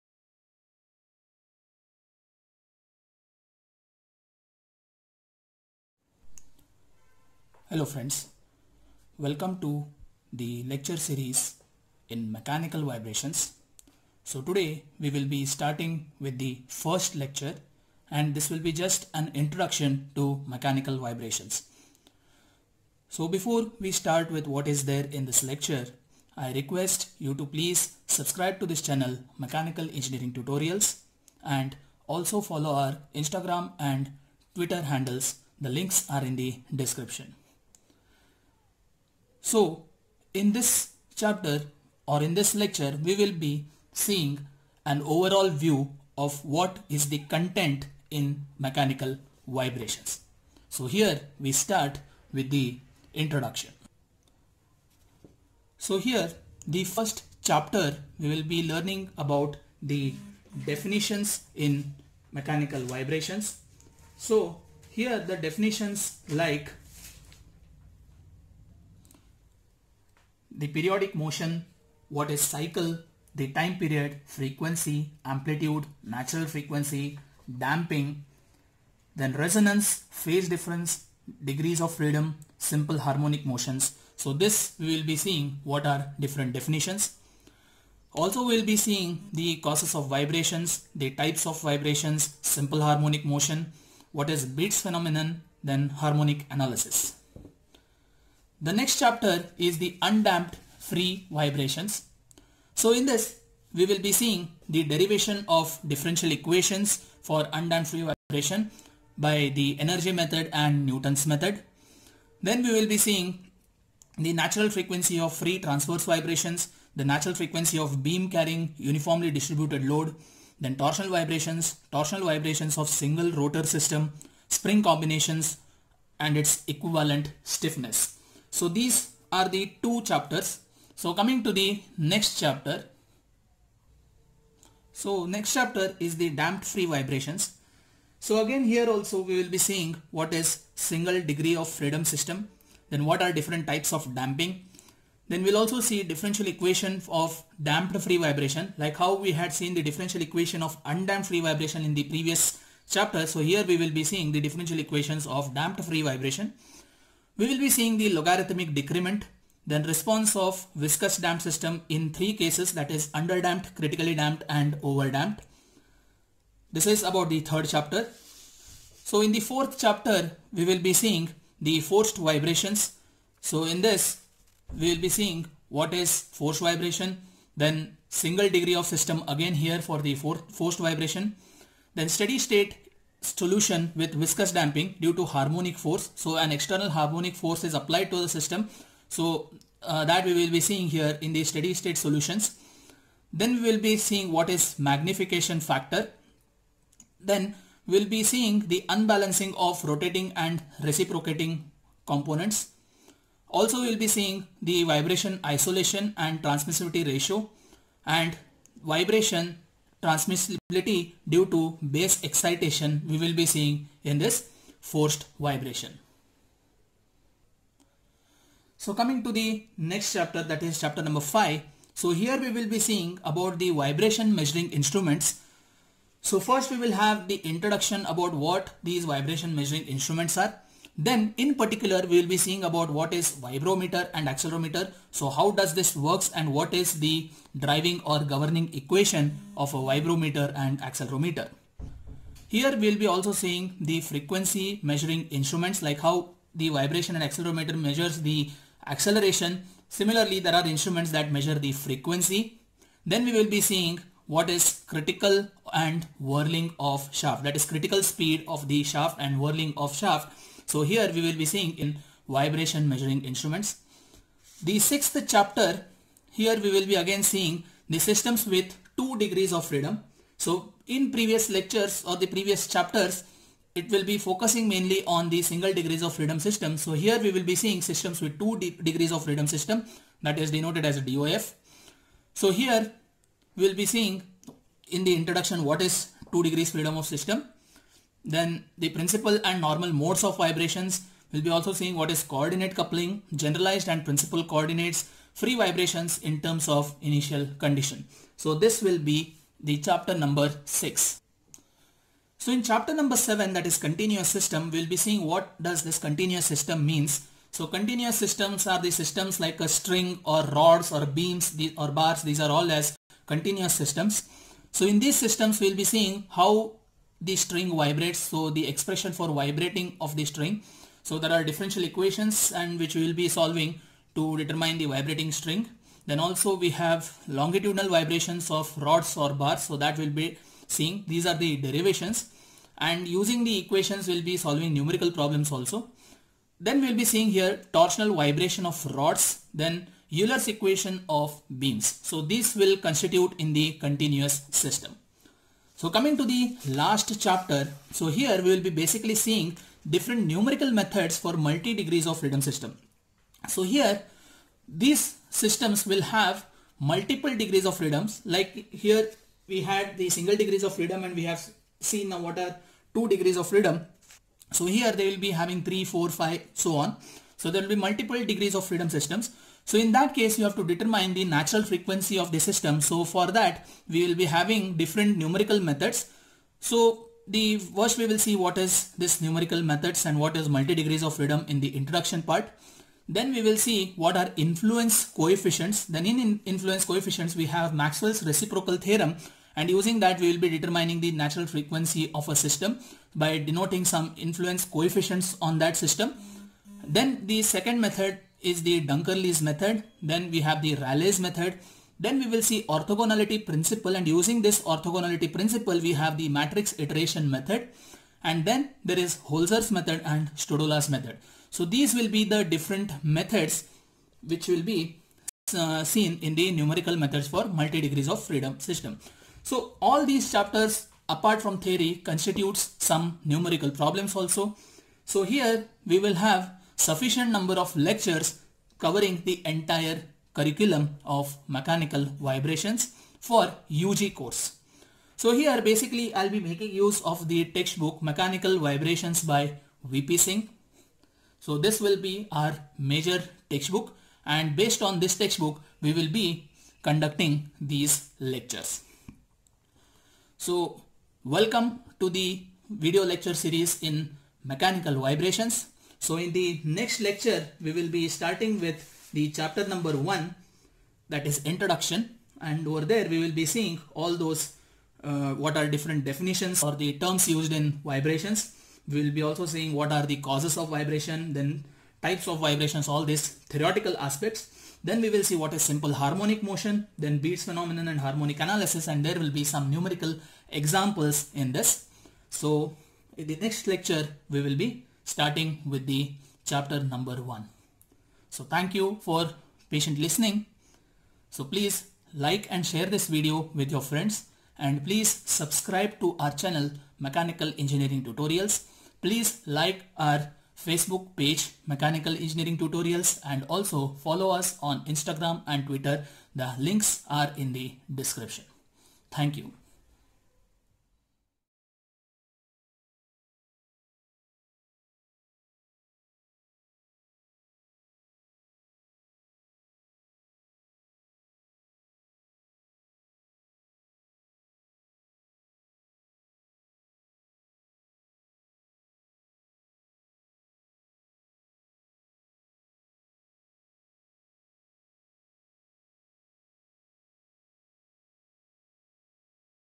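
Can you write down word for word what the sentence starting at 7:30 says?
So welcome to the video lecture series in Mechanical Vibrations.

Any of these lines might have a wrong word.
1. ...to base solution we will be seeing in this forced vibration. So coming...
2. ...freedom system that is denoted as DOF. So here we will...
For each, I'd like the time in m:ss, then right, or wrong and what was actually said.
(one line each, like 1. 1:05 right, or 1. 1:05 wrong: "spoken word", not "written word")
1. 3:31 wrong: "excitation", not "solution"
2. 4:39 right.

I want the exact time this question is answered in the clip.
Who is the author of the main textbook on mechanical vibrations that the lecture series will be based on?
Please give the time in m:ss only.
7:19.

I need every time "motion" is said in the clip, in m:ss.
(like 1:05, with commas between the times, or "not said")
1:11, 1:23, 1:33, 7:56.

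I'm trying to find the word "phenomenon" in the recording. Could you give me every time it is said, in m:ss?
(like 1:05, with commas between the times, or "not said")
1:34, 7:57.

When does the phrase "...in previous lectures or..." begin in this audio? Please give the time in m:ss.
4:30.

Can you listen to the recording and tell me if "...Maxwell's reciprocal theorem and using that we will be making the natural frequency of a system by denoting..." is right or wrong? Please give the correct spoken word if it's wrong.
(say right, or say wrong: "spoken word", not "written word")
wrong: "determining", not "making".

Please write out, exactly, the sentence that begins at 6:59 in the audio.
So all these chapters apart from theory constitutes some numerical problems also.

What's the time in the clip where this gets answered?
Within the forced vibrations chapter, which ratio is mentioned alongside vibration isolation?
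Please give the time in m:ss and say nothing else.
3:26.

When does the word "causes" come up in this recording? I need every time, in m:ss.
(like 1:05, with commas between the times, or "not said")
1:29, 7:50.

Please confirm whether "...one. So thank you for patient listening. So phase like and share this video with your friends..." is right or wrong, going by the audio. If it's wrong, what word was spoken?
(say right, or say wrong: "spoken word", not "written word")
wrong: "please", not "phase".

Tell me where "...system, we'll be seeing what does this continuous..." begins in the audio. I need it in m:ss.
5:04.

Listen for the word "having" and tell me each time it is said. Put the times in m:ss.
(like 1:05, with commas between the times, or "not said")
6:05, 6:14.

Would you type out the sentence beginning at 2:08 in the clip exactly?
So these are the two chapters.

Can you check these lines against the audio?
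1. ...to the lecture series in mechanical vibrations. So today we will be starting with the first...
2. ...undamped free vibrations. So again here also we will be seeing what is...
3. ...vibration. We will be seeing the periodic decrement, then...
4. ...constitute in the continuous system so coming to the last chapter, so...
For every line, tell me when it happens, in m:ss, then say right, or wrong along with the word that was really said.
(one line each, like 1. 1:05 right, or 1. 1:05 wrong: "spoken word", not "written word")
1. 0:09 right
2. 2:16 wrong: "damped", not "undamped"
3. 2:36 wrong: "logarithmic", not "periodic"
4. 5:42 right.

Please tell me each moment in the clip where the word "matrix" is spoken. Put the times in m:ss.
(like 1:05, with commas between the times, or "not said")
6:46.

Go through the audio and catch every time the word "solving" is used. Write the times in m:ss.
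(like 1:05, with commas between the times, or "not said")
5:23, 5:34.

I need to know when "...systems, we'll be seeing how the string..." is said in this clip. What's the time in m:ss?
5:15.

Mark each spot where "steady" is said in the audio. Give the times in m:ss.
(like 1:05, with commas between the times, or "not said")
3:02, 3:11.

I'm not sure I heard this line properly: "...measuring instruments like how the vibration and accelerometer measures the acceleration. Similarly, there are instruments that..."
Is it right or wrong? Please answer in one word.
right.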